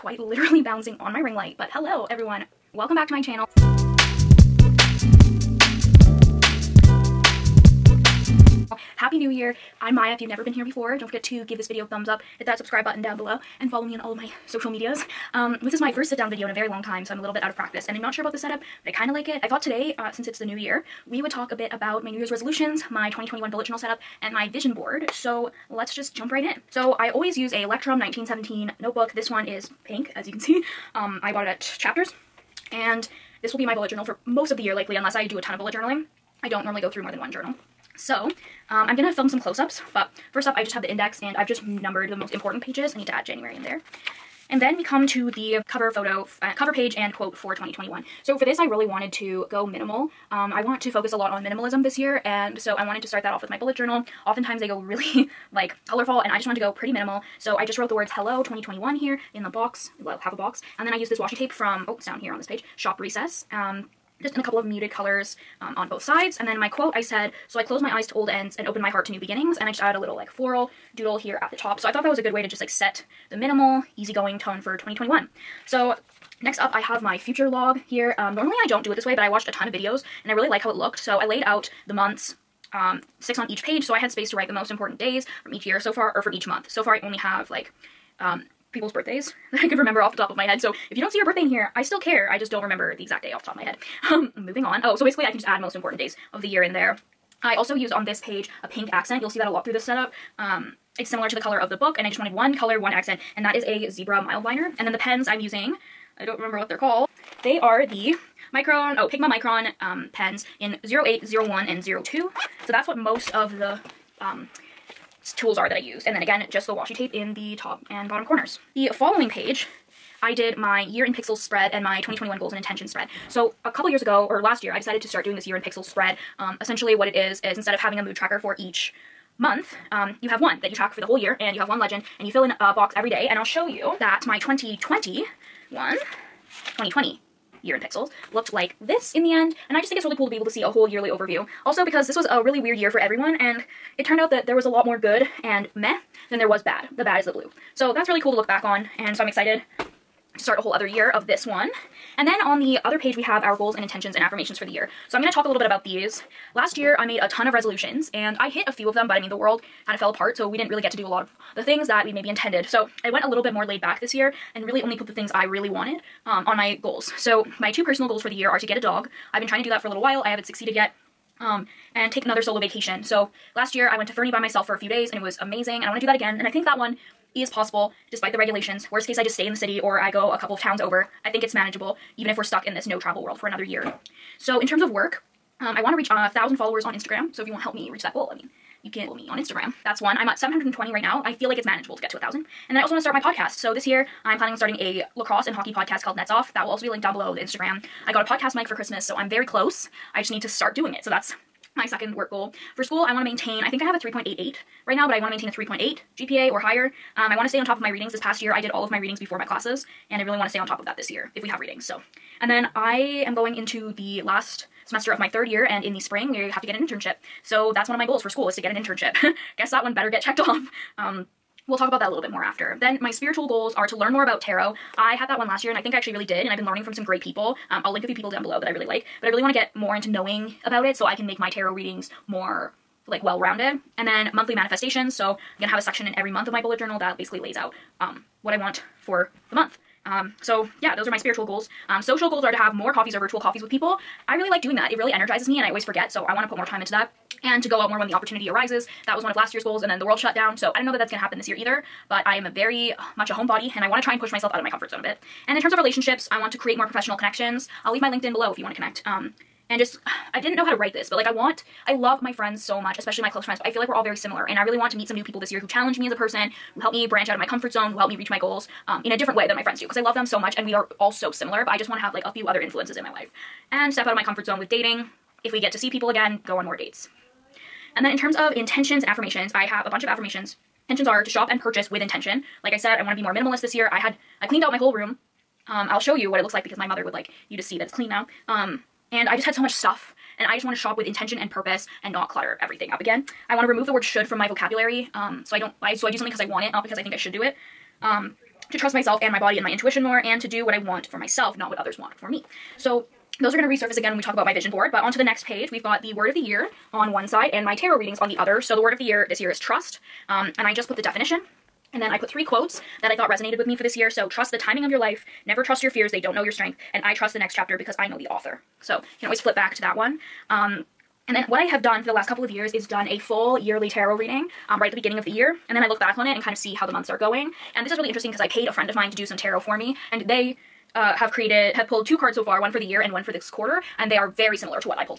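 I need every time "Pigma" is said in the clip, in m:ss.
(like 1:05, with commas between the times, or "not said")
1:49.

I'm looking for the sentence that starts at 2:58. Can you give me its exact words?
Worst case, I just stay in the city or I go a couple of towns over.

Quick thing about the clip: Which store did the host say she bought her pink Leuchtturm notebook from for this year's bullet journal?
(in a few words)
Chapters.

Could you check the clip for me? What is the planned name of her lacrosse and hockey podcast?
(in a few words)
Nets Off.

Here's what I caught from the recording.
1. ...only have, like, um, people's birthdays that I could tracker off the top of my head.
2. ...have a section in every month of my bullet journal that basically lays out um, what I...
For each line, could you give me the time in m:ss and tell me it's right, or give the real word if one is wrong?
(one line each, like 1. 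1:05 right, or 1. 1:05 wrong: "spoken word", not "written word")
1. 1:27 wrong: "remember", not "tracker"
2. 3:55 right.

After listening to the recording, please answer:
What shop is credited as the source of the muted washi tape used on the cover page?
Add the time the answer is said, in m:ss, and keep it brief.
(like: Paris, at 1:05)
Shop Recess, at 1:02.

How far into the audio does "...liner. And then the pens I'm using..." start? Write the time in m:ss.
1:44.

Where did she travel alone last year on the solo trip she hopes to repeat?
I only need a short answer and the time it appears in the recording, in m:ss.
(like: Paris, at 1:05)
Fernie, at 2:54.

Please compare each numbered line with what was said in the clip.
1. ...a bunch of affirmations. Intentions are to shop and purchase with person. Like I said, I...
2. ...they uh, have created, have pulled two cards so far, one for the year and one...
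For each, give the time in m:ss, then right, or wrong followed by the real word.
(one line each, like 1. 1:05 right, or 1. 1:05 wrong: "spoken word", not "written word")
1. 4:39 wrong: "intention", not "person"
2. 5:30 right.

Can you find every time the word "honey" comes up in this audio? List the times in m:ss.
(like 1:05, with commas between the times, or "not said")
not said.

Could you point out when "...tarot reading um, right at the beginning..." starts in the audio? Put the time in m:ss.
5:23.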